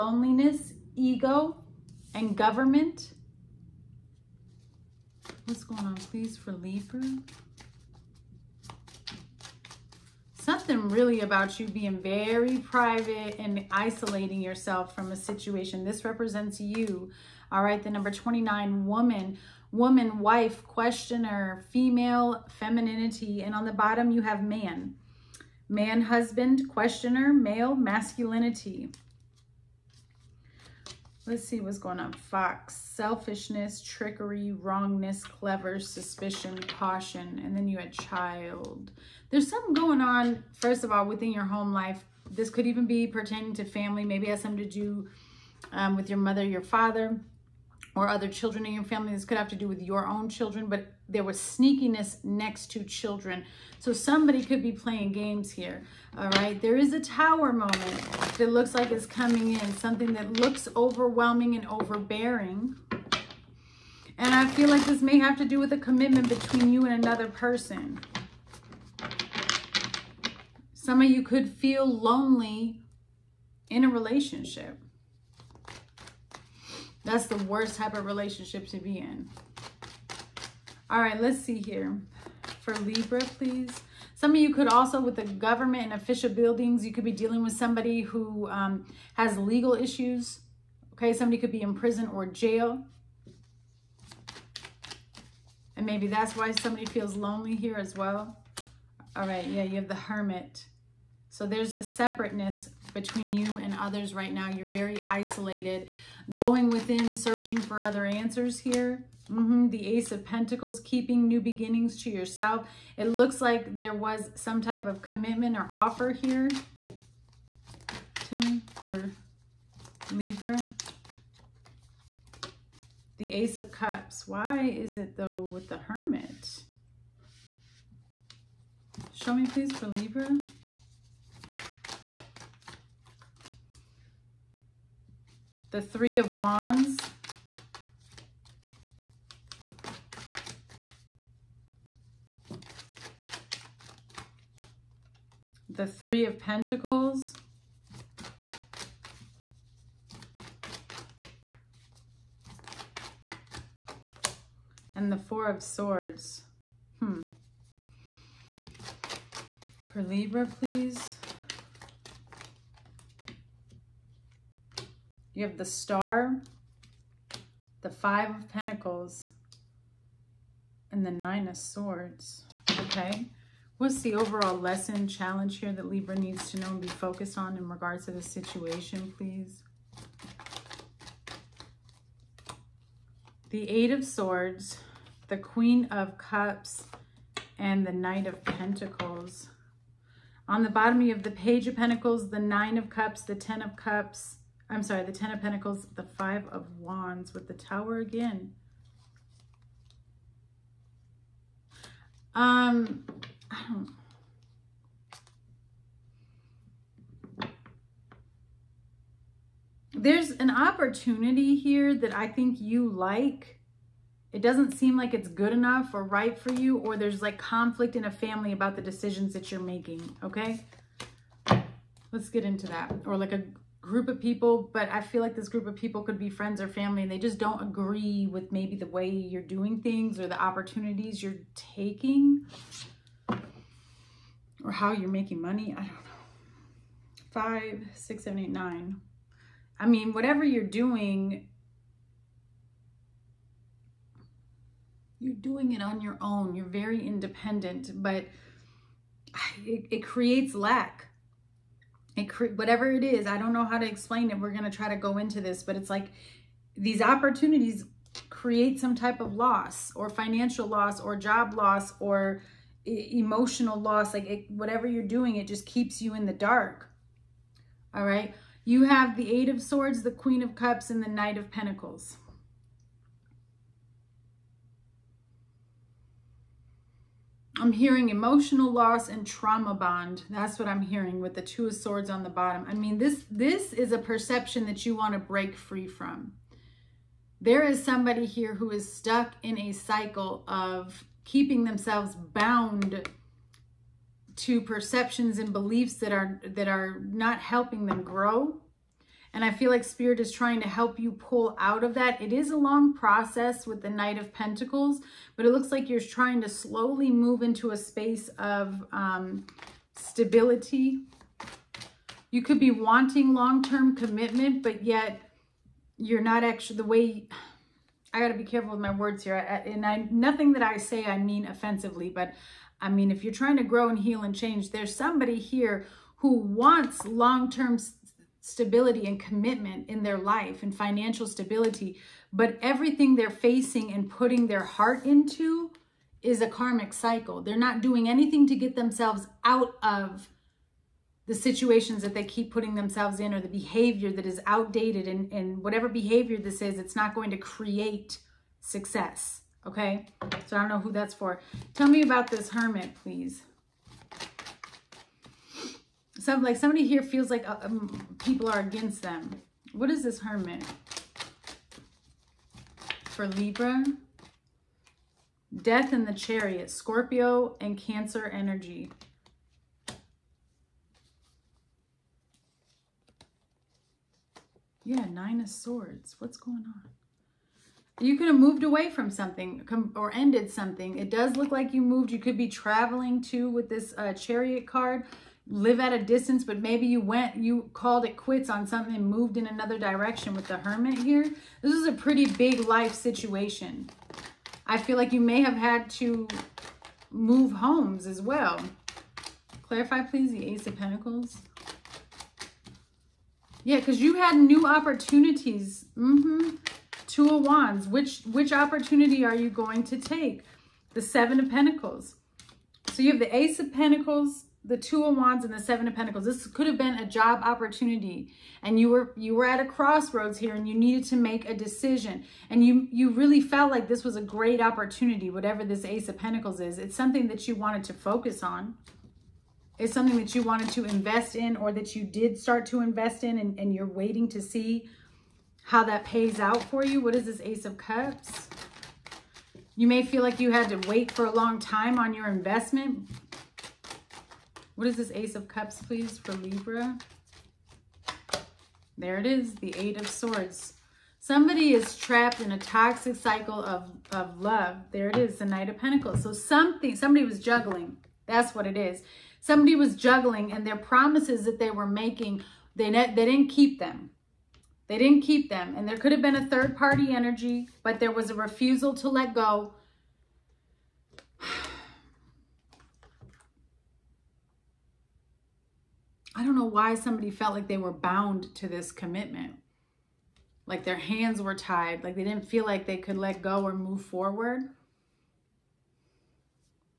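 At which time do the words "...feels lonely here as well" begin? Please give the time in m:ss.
1:36.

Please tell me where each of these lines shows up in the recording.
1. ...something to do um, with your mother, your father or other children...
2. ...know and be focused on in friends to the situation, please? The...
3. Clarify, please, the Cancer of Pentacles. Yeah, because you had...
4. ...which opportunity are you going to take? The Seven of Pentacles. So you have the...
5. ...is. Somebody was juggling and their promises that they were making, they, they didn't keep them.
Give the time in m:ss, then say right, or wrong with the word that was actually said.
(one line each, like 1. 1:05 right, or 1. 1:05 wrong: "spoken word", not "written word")
1. 0:44 right
2. 2:56 wrong: "regards", not "friends"
3. 6:39 wrong: "Ace", not "Cancer"
4. 6:48 right
5. 7:38 right.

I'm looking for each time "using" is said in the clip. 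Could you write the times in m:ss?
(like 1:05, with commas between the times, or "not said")
not said.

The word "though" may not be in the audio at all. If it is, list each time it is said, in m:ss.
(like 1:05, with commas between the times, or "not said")
2:05.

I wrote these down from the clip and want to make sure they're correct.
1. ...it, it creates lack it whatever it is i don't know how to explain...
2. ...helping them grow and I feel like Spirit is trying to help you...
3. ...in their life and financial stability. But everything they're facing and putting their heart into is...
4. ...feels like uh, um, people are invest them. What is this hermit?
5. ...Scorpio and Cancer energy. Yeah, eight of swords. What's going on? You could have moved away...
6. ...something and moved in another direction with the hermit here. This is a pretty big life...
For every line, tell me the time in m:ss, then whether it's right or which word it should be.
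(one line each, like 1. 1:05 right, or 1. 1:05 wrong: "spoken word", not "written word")
1. 4:09 right
2. 4:57 right
3. 5:29 right
4. 5:57 wrong: "against", not "invest"
5. 6:06 wrong: "nine", not "eight"
6. 6:28 right.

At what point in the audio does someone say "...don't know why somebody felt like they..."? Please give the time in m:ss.
7:56.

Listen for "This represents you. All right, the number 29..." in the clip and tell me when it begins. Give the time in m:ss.
0:15.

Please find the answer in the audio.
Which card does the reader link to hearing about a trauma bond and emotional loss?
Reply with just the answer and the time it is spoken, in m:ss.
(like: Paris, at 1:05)
Two of Swords, at 4:41.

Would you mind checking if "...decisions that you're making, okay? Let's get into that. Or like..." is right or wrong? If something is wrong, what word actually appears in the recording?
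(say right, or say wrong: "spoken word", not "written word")
right.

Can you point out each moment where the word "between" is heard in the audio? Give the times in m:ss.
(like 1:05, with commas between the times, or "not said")
1:06, 1:42.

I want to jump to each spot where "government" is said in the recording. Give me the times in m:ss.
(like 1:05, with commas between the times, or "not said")
0:02, 1:25.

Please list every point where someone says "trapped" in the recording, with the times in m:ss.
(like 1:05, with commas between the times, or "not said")
7:31.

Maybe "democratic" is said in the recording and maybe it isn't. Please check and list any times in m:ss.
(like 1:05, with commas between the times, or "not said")
not said.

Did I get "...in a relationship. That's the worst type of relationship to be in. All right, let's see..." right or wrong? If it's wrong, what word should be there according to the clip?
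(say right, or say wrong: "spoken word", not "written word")
right.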